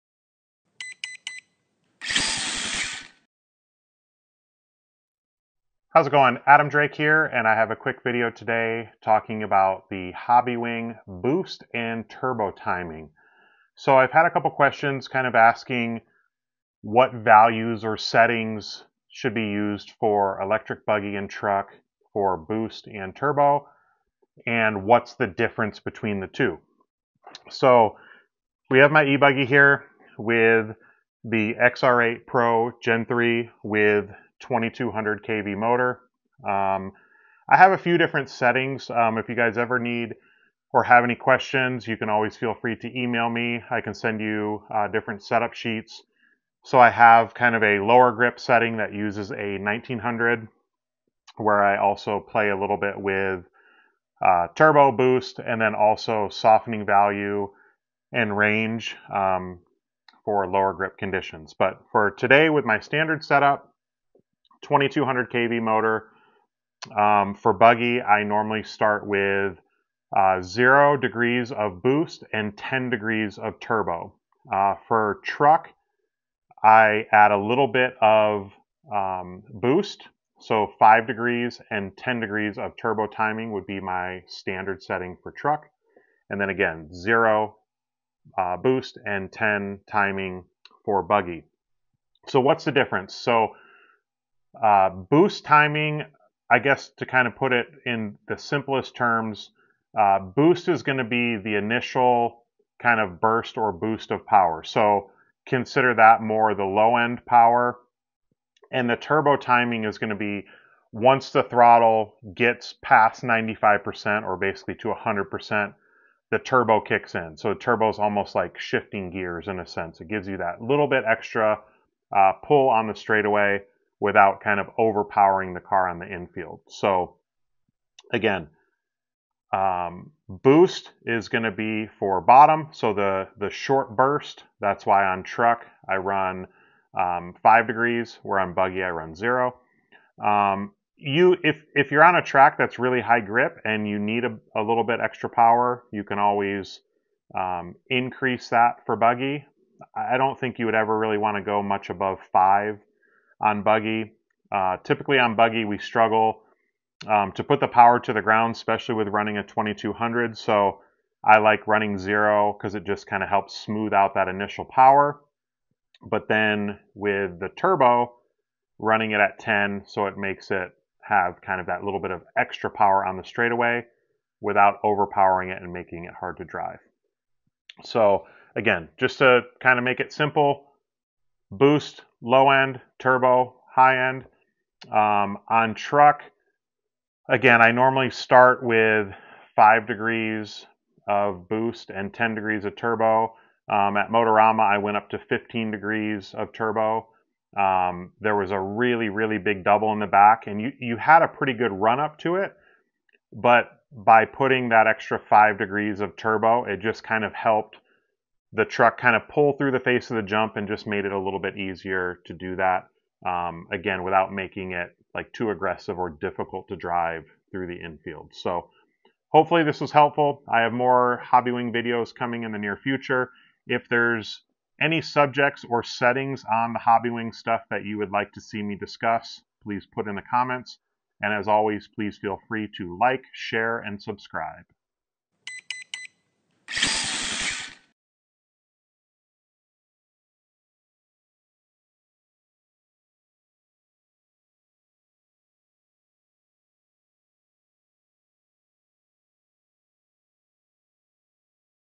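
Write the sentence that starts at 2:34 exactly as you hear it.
Uh, typically on buggy, we struggle um, to put the power to the ground, especially with running a 2200.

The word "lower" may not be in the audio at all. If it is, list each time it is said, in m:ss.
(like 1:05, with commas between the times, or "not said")
0:47, 1:00.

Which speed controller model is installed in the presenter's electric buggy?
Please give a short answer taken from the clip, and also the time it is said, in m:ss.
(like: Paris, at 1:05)
XR8 Pro Gen 3, at 0:31.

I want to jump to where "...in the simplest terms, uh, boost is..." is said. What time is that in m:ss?
1:37.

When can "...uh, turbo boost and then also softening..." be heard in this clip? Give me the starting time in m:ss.
0:54.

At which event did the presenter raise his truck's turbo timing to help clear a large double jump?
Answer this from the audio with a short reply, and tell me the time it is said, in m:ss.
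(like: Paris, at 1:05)
Motorama, at 3:14.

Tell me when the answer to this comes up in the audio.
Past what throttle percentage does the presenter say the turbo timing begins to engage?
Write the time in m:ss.
1:53.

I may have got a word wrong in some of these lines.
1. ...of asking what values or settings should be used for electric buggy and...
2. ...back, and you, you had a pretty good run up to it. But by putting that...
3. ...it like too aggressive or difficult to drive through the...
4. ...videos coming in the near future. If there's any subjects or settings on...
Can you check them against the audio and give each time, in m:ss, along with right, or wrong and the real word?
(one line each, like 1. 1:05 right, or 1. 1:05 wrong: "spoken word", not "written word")
1. 0:15 right
2. 3:20 right
3. 3:34 right
4. 3:41 right.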